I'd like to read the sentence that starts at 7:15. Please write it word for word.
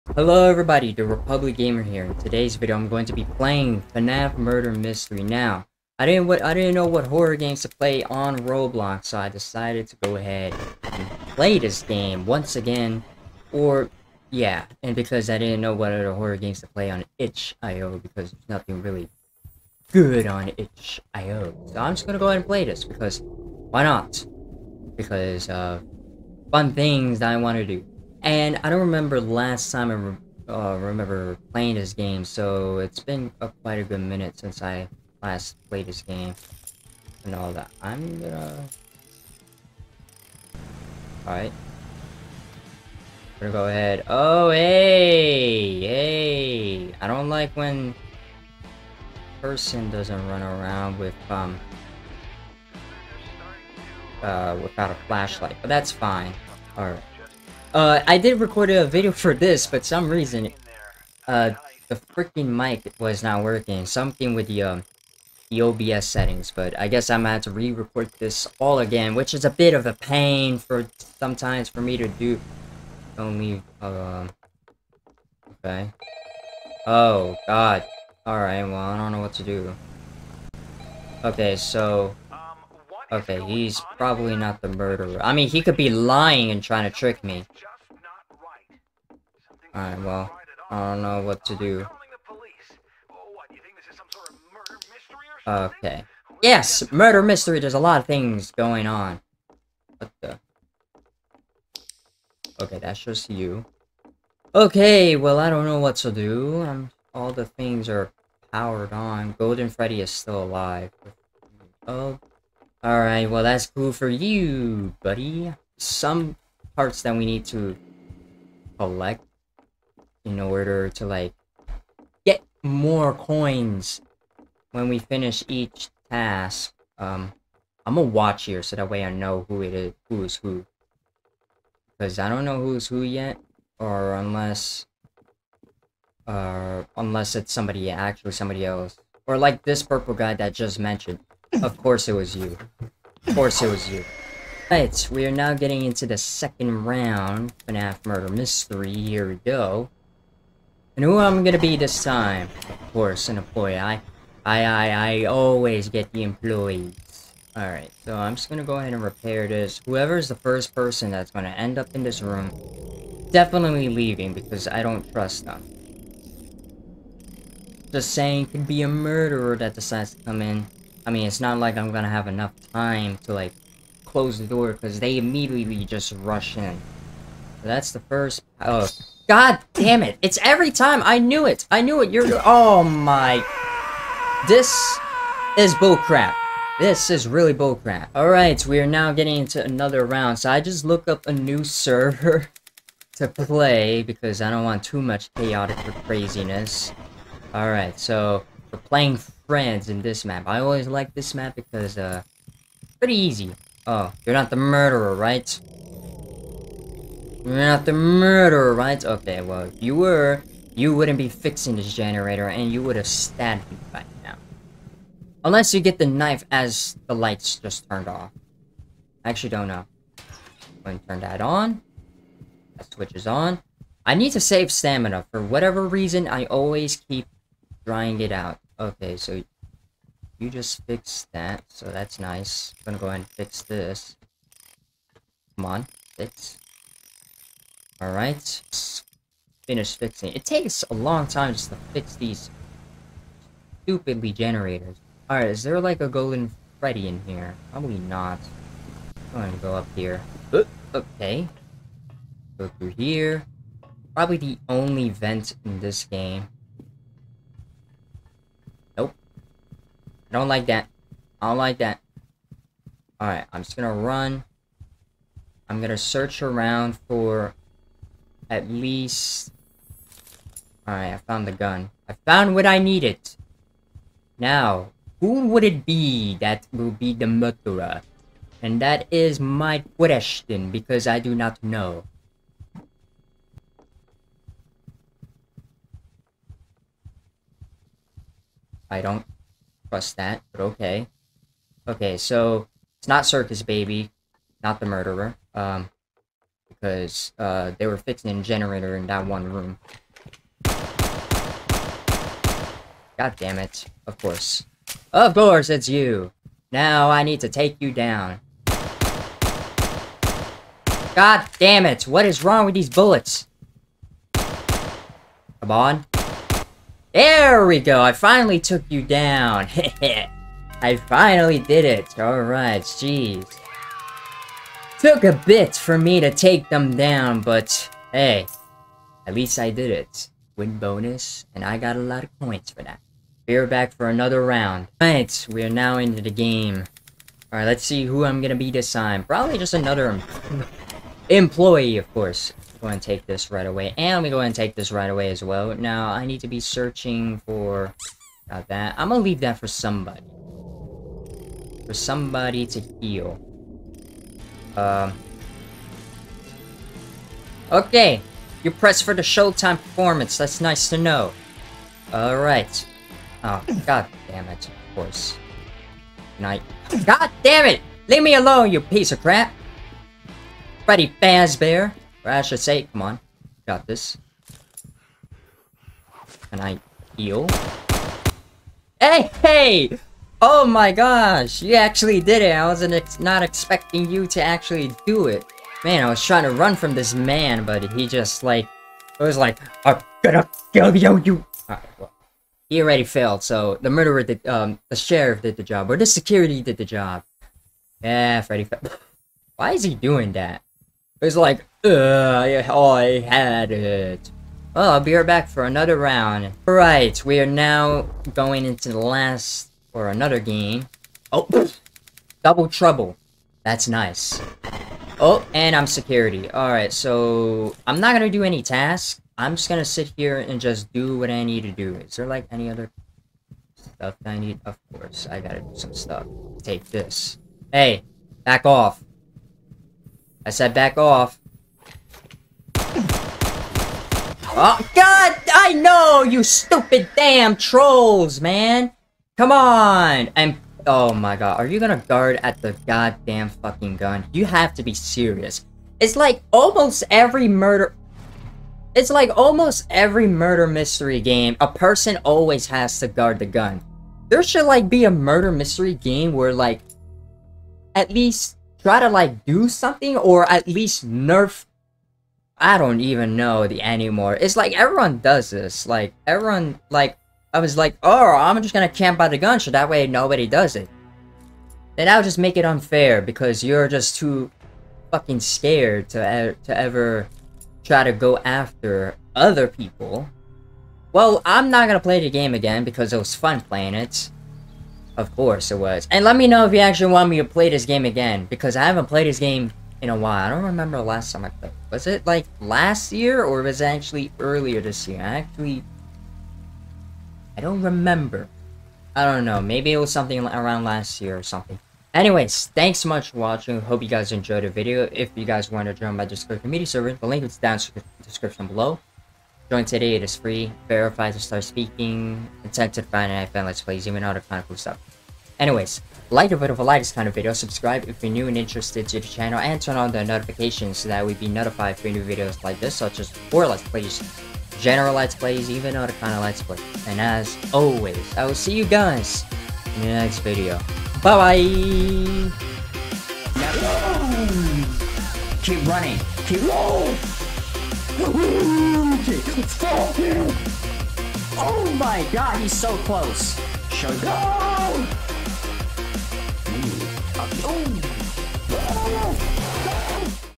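I know, you stupid damn trolls, man!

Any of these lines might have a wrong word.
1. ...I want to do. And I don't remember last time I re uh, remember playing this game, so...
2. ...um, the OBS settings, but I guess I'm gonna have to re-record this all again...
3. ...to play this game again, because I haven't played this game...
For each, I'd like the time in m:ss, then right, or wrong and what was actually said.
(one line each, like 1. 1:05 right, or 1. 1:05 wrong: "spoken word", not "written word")
1. 0:27 right
2. 1:04 right
3. 8:07 right.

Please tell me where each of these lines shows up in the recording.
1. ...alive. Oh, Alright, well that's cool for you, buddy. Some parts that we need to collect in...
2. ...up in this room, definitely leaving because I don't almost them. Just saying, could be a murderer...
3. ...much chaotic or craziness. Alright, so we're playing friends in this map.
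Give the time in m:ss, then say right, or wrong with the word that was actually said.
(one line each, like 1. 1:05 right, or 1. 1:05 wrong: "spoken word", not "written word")
1. 1:50 right
2. 2:41 wrong: "trust", not "almost"
3. 3:15 right.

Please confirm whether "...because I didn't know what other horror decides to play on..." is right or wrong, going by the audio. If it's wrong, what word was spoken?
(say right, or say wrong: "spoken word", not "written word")
wrong: "games", not "decides".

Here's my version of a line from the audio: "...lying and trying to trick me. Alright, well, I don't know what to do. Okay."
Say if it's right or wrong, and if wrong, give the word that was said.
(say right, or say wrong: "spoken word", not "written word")
right.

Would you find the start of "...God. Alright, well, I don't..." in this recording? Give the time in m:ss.
1:17.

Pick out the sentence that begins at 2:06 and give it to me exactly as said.
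Um, I'm gonna watch here so that way I know who it is, who is who.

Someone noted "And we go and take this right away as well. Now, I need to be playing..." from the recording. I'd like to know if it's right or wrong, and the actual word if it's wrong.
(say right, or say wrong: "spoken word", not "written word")
wrong: "searching", not "playing".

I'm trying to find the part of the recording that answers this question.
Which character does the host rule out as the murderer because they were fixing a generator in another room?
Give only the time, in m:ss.
4:53.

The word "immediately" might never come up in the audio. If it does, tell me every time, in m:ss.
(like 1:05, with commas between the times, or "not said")
2:55.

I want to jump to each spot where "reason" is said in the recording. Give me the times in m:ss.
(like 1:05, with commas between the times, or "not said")
1:00, 3:45.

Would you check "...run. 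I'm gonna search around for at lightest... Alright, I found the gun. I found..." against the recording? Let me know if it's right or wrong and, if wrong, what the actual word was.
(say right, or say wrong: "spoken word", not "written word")
wrong: "least", not "lightest".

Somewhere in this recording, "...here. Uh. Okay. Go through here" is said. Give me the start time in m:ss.
4:09.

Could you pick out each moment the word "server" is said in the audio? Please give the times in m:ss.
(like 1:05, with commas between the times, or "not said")
3:11, 8:26.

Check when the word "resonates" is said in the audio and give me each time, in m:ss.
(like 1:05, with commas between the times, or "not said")
not said.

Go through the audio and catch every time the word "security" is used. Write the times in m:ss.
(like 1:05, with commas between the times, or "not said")
6:36, 6:55.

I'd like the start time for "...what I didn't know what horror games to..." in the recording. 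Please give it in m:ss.
0:06.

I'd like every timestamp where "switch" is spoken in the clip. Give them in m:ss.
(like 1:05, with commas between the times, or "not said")
3:42.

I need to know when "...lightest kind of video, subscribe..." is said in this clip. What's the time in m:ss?
8:36.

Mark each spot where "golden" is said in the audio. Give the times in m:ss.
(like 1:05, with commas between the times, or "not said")
1:49, 4:06.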